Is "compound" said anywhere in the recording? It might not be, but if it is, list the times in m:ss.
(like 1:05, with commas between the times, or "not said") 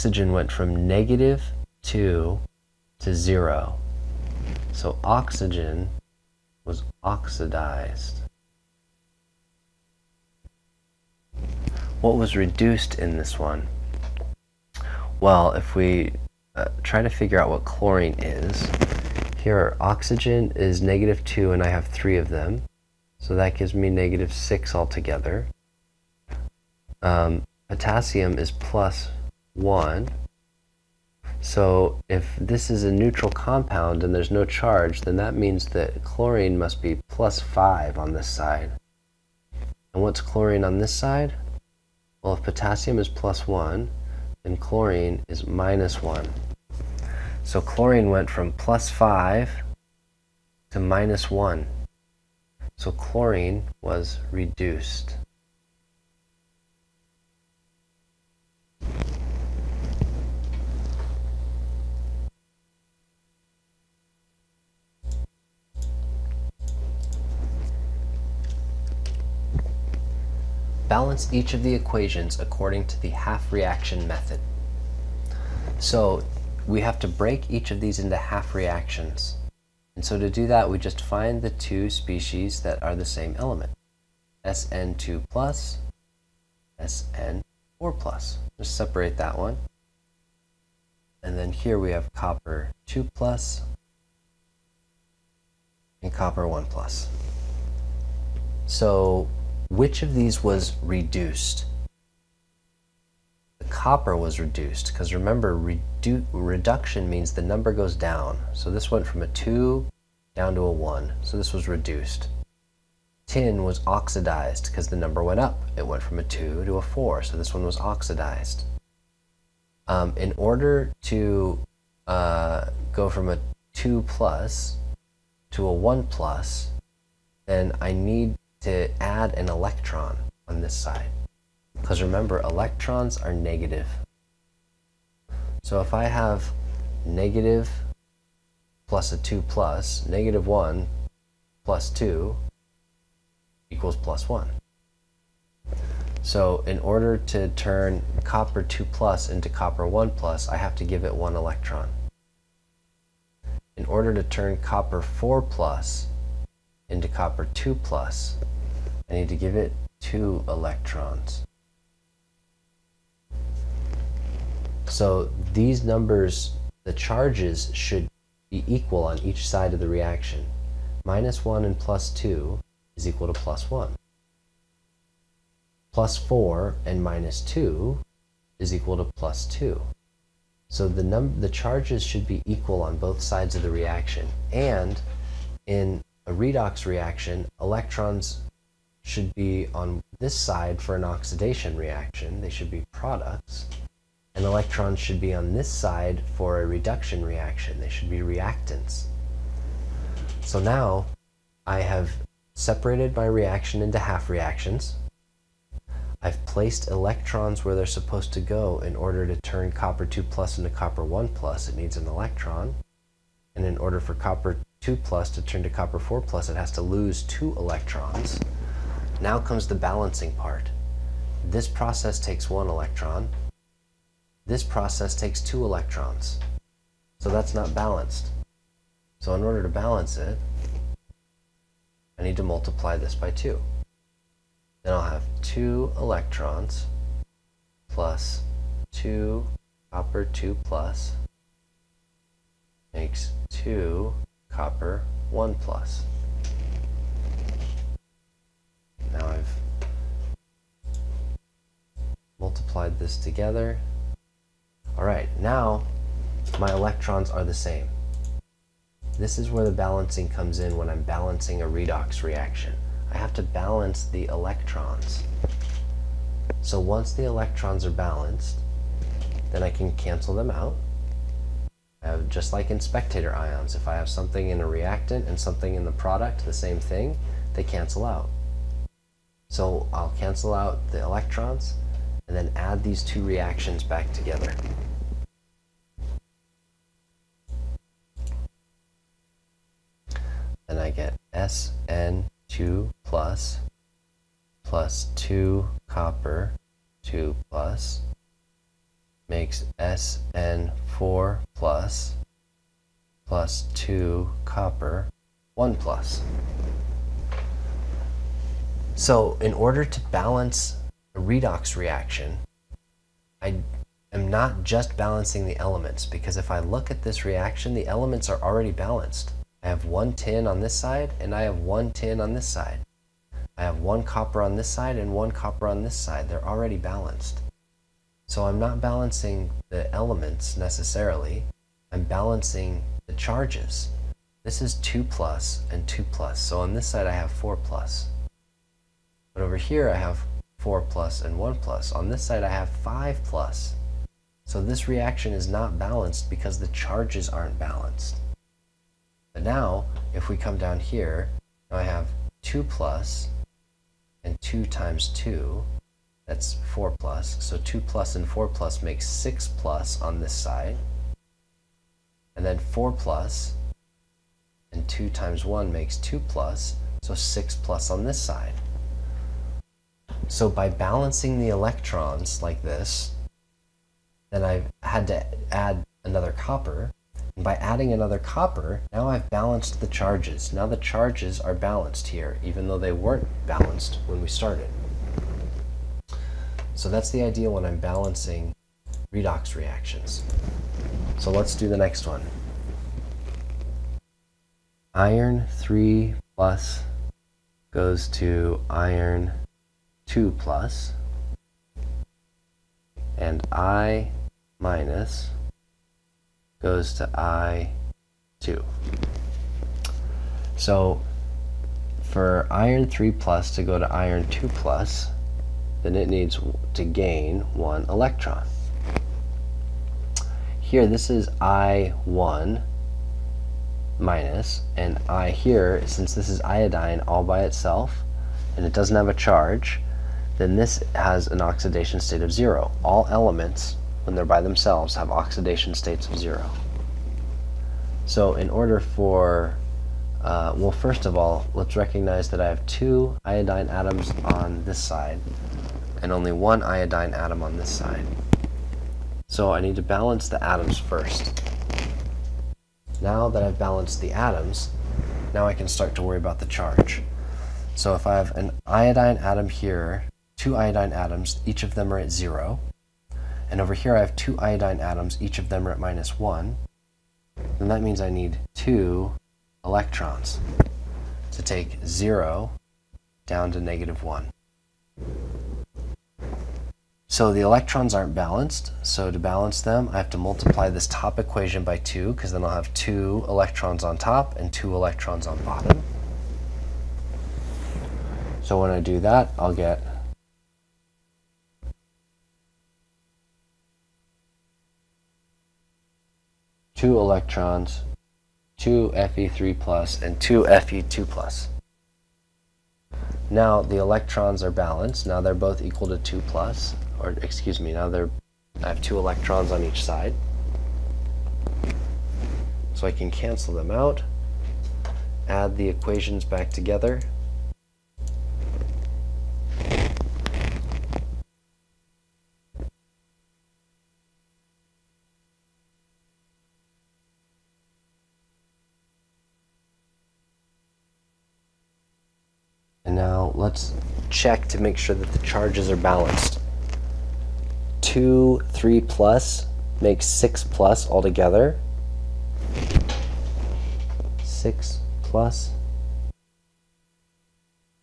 0:33.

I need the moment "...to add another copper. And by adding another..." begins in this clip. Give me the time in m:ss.
6:15.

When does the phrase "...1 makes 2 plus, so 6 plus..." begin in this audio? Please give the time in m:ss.
6:05.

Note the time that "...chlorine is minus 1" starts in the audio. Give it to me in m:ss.
0:44.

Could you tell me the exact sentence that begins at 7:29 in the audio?
So I need to balance the atoms first.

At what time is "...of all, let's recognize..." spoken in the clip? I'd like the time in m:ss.
7:21.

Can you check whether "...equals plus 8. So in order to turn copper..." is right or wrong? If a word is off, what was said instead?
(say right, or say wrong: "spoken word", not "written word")
wrong: "1", not "8".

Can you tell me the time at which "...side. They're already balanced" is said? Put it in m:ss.
5:25.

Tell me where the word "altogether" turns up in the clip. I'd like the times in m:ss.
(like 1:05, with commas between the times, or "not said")
0:24, 9:00.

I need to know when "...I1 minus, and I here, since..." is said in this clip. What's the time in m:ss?
7:01.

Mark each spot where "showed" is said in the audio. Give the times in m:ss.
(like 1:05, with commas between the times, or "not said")
not said.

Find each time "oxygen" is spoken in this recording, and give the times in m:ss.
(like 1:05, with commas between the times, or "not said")
0:05, 0:19.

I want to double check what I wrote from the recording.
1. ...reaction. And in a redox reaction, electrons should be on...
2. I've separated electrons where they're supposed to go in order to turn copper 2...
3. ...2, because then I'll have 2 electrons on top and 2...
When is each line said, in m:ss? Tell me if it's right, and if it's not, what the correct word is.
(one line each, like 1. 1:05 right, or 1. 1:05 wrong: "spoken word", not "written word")
1. 3:03 right
2. 3:26 wrong: "placed", not "separated"
3. 8:01 right.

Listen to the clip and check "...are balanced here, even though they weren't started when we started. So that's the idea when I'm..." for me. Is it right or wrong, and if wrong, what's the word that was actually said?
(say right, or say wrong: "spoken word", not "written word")
wrong: "balanced", not "started".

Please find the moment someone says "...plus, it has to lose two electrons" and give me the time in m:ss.
3:36.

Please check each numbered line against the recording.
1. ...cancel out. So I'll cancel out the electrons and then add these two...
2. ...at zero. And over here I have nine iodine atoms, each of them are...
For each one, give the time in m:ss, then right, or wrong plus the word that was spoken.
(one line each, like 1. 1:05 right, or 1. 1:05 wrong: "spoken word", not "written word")
1. 4:37 right
2. 7:41 wrong: "two", not "nine".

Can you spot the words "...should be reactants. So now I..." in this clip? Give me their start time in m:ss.
3:17.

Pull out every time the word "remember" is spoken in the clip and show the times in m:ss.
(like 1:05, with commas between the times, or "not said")
1:45, 2:12.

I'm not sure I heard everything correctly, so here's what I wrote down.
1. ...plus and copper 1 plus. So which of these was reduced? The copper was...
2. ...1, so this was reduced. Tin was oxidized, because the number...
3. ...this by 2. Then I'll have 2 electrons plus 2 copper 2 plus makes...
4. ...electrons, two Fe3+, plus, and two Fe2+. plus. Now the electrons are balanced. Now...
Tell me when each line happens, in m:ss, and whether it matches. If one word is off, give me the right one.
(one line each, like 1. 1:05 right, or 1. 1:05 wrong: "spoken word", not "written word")
1. 1:33 right
2. 1:50 right
3. 3:52 right
4. 8:16 right.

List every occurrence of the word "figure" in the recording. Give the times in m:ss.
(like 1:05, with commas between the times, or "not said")
0:17.